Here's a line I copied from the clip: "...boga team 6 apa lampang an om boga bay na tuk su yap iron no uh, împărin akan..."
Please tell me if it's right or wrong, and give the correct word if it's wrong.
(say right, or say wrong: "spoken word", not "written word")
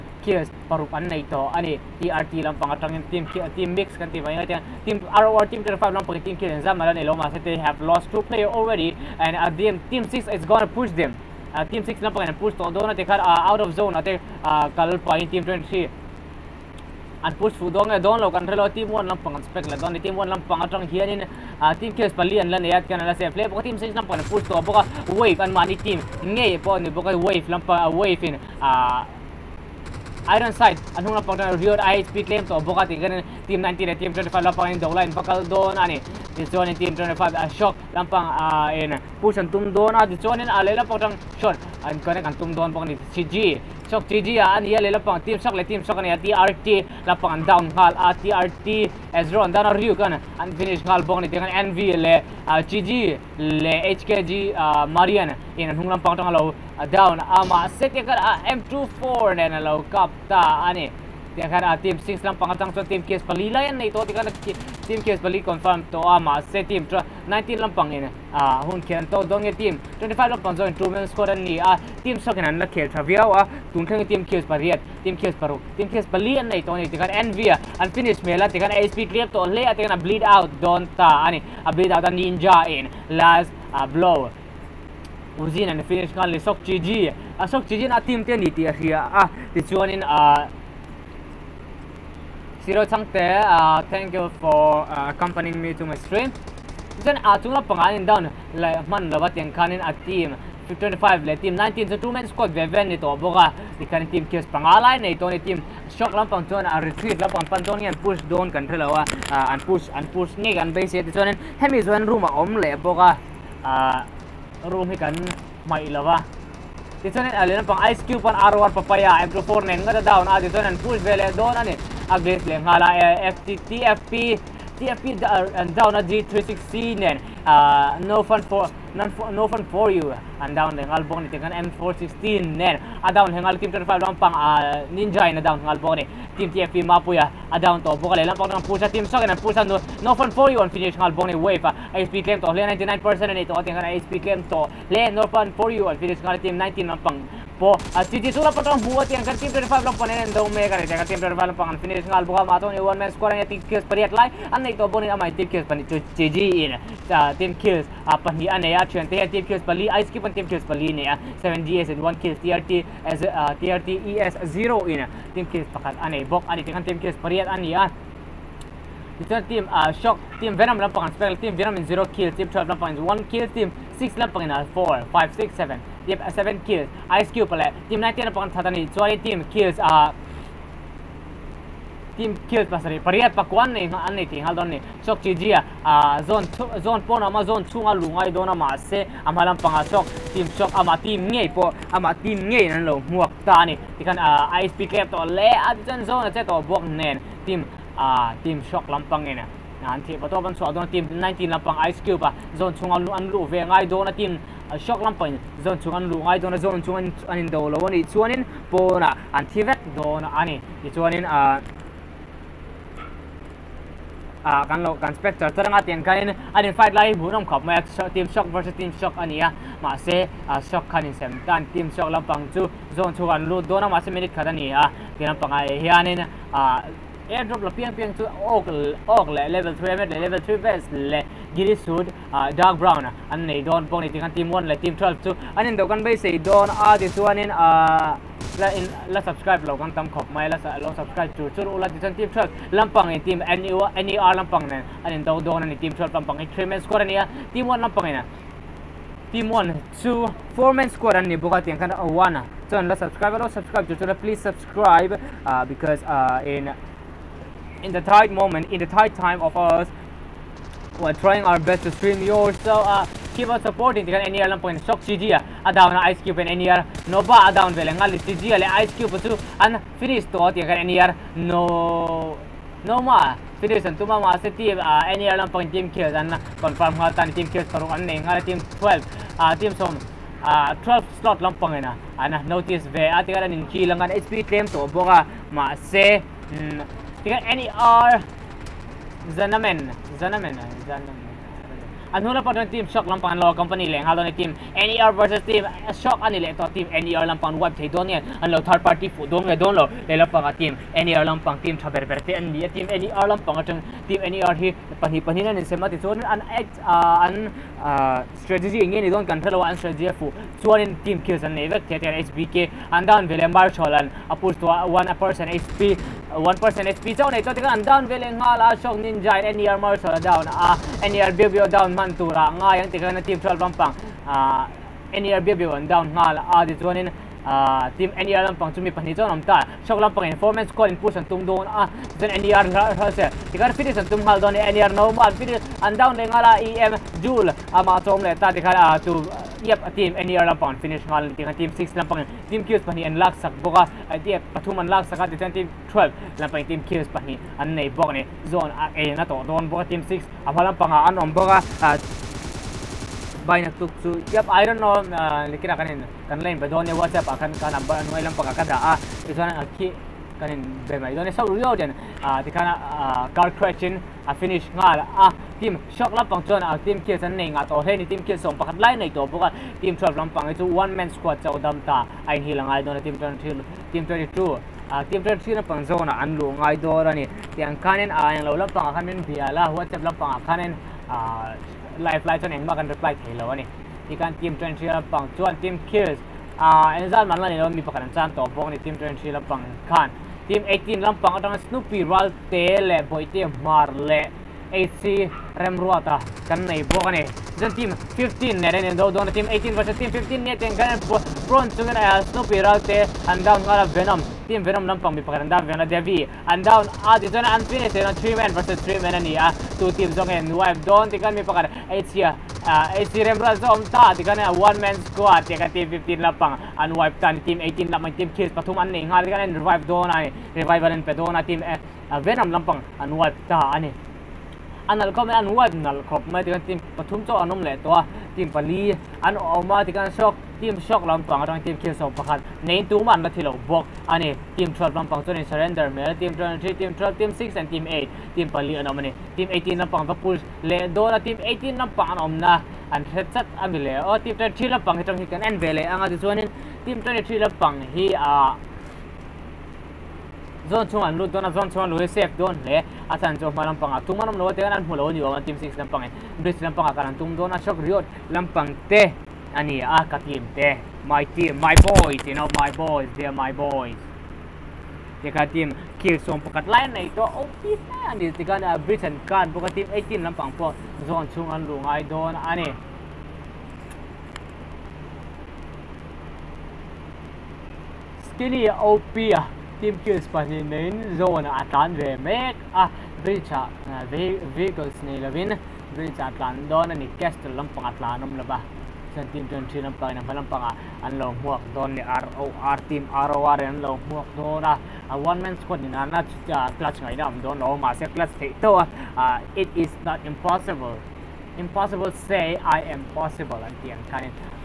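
wrong: "likin", not "împărin".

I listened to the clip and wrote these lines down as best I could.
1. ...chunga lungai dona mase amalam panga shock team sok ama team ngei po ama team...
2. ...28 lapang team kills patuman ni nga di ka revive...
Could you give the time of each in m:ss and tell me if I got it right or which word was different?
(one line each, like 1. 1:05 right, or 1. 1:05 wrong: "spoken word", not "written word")
1. 3:07 right
2. 6:57 wrong: "18", not "28".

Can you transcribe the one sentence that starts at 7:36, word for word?
bris lampang kan an tum dona shock riot lampang teh.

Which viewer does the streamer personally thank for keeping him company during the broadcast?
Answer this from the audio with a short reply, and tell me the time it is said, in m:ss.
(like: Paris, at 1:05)
Siro Changte, at 1:32.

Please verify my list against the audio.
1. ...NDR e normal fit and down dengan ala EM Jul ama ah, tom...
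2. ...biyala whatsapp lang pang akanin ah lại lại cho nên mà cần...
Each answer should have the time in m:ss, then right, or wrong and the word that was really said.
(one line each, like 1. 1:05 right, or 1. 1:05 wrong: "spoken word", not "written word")
1. 5:34 right
2. 6:19 right.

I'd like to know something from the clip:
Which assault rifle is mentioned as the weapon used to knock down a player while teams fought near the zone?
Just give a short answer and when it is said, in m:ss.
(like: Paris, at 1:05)
M416, at 2:11.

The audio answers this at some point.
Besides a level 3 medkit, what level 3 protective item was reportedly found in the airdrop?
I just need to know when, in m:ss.
3:50.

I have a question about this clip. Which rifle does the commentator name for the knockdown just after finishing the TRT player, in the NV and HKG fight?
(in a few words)
M24.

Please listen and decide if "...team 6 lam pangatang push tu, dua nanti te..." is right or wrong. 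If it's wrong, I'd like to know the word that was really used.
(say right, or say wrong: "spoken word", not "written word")
right.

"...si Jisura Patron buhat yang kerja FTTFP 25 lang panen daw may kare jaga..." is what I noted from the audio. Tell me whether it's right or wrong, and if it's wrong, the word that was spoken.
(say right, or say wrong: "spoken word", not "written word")
wrong: "Team", not "FTTFP".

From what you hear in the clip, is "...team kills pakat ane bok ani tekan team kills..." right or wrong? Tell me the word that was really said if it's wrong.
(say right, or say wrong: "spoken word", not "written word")
right.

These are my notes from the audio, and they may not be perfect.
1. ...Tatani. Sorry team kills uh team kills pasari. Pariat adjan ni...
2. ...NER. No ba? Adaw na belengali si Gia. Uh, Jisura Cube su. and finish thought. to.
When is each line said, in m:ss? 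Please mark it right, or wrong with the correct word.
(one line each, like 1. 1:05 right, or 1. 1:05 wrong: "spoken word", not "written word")
1. 2:58 wrong: "pakwan", not "adjan"
2. 4:26 wrong: "Ice", not "Jisura".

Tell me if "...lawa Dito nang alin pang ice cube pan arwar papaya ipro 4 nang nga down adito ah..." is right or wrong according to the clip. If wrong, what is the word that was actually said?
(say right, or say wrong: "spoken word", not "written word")
right.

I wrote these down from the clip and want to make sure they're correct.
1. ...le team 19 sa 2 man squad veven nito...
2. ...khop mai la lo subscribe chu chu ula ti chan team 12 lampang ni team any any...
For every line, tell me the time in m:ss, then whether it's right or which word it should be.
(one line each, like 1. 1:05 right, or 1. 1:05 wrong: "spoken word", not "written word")
1. 1:41 right
2. 4:00 right.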